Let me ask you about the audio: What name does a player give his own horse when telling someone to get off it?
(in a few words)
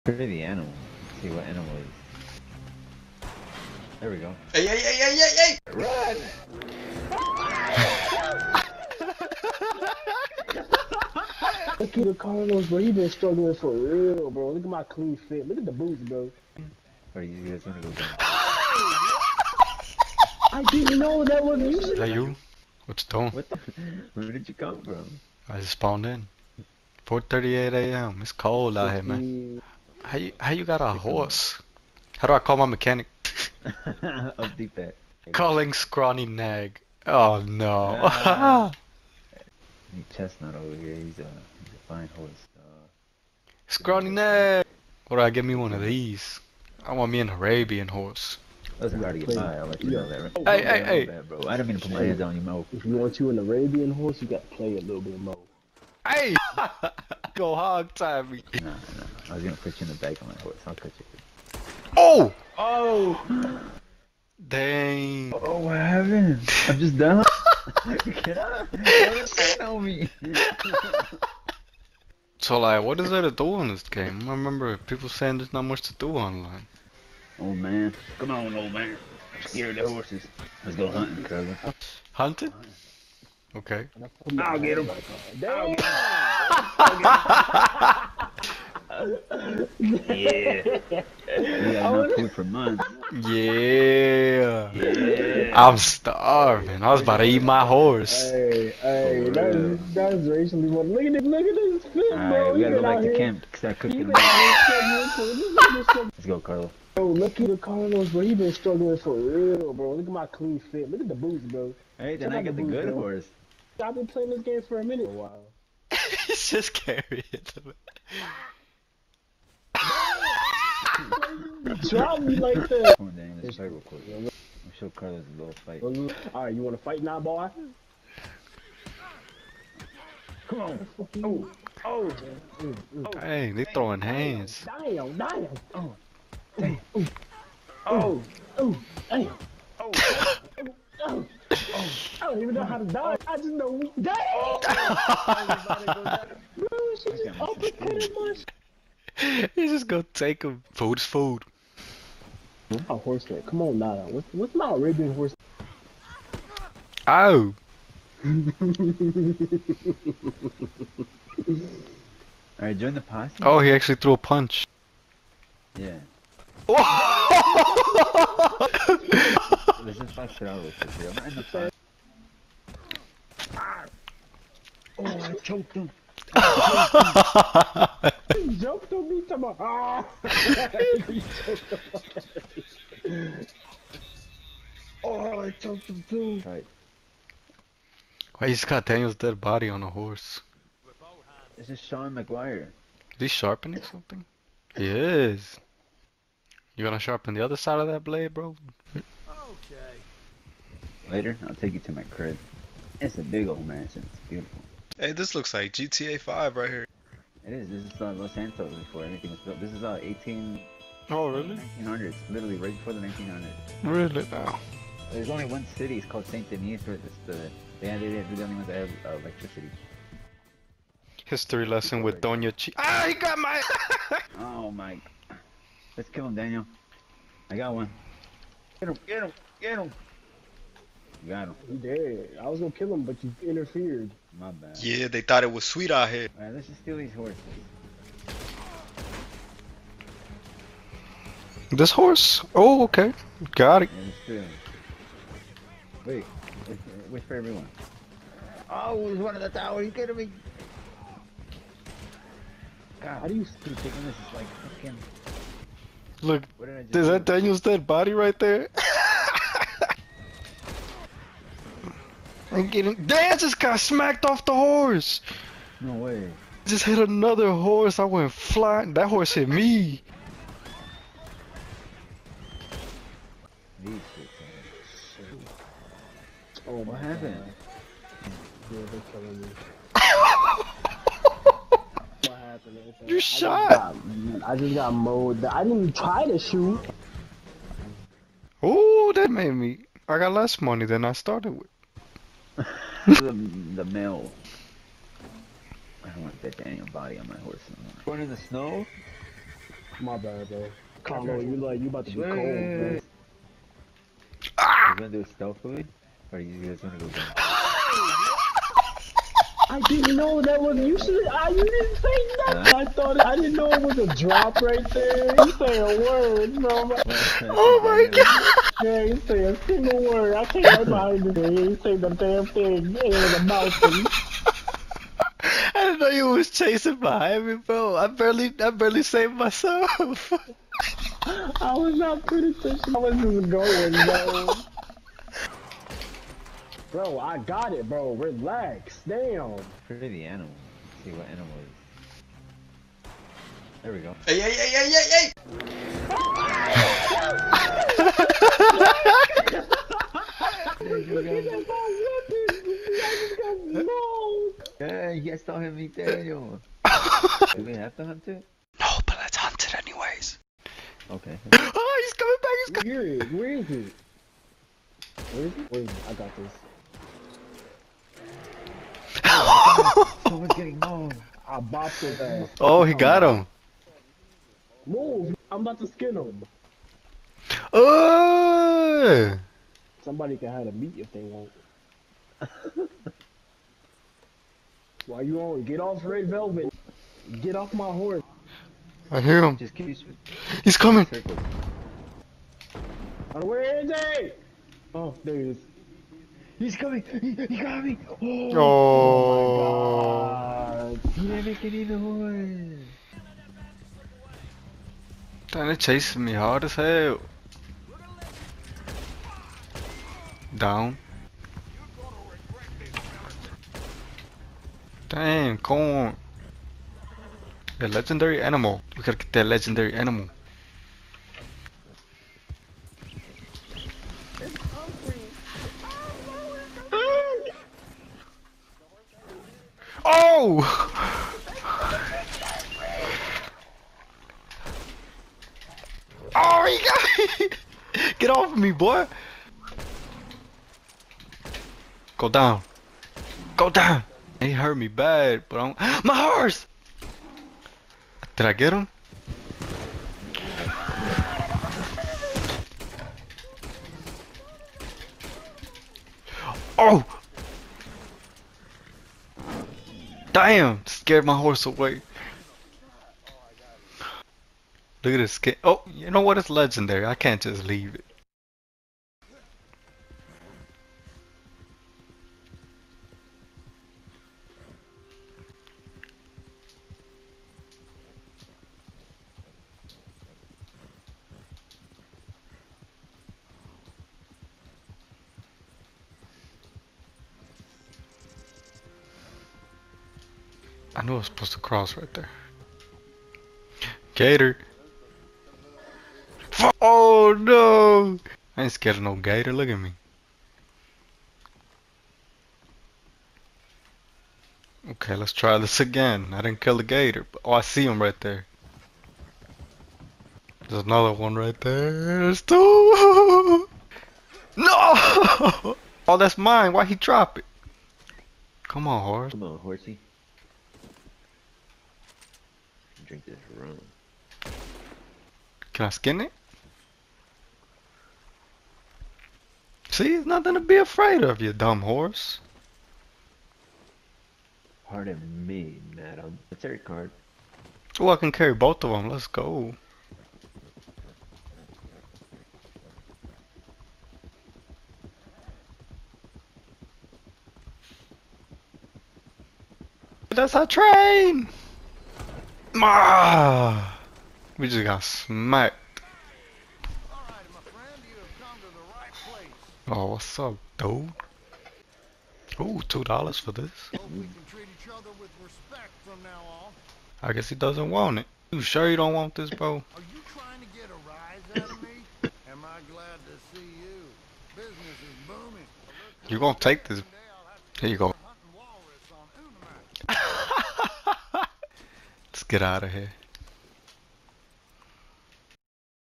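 Red Velvet.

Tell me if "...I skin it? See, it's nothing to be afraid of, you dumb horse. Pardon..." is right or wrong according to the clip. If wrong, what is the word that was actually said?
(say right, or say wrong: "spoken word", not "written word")
right.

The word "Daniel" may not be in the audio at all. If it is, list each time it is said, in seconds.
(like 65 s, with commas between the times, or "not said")
226 s, 257 s, 355 s.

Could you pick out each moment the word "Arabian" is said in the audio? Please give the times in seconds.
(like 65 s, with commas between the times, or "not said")
47 s, 53 s, 154 s.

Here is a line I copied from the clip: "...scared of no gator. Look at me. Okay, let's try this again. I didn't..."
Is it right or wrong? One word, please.
right.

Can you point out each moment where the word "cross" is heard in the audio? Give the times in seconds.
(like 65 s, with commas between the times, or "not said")
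491 s.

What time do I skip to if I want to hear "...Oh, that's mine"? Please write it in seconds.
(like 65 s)
516 s.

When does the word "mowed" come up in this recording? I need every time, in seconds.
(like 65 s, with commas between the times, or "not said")
284 s.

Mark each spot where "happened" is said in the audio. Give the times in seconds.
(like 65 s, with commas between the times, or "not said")
65 s, 277 s.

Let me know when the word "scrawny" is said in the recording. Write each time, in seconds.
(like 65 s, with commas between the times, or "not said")
35 s, 43 s.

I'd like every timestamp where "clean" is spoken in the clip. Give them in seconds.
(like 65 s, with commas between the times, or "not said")
14 s, 110 s.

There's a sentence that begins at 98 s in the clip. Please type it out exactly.
Hey, hey, that's, that's racially Look at this, look at this fit, bro.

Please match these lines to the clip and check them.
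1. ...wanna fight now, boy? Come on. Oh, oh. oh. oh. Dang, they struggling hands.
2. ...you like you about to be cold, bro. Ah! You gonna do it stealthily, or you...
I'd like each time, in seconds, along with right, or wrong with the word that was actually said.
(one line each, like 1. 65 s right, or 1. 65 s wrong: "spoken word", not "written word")
1. 126 s wrong: "throwing", not "struggling"
2. 301 s right.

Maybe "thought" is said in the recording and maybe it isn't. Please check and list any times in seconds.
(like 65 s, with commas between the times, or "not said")
235 s, 312 s.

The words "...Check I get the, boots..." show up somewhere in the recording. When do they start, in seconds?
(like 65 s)
112 s.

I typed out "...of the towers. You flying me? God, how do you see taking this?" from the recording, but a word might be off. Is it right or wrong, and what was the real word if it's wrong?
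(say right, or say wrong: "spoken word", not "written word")
wrong: "kidding", not "flying".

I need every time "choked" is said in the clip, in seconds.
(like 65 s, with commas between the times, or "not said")
175 s, 185 s.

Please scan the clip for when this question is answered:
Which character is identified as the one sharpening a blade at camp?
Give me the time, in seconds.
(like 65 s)
191 s.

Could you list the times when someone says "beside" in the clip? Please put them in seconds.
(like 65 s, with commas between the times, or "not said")
not said.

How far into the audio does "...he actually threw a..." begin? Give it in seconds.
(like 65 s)
163 s.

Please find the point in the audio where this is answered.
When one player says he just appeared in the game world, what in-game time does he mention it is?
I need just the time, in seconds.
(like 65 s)
27 s.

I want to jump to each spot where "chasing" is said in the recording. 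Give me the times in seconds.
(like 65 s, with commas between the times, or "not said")
326 s, 405 s.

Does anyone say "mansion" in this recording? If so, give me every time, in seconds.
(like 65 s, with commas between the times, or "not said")
203 s.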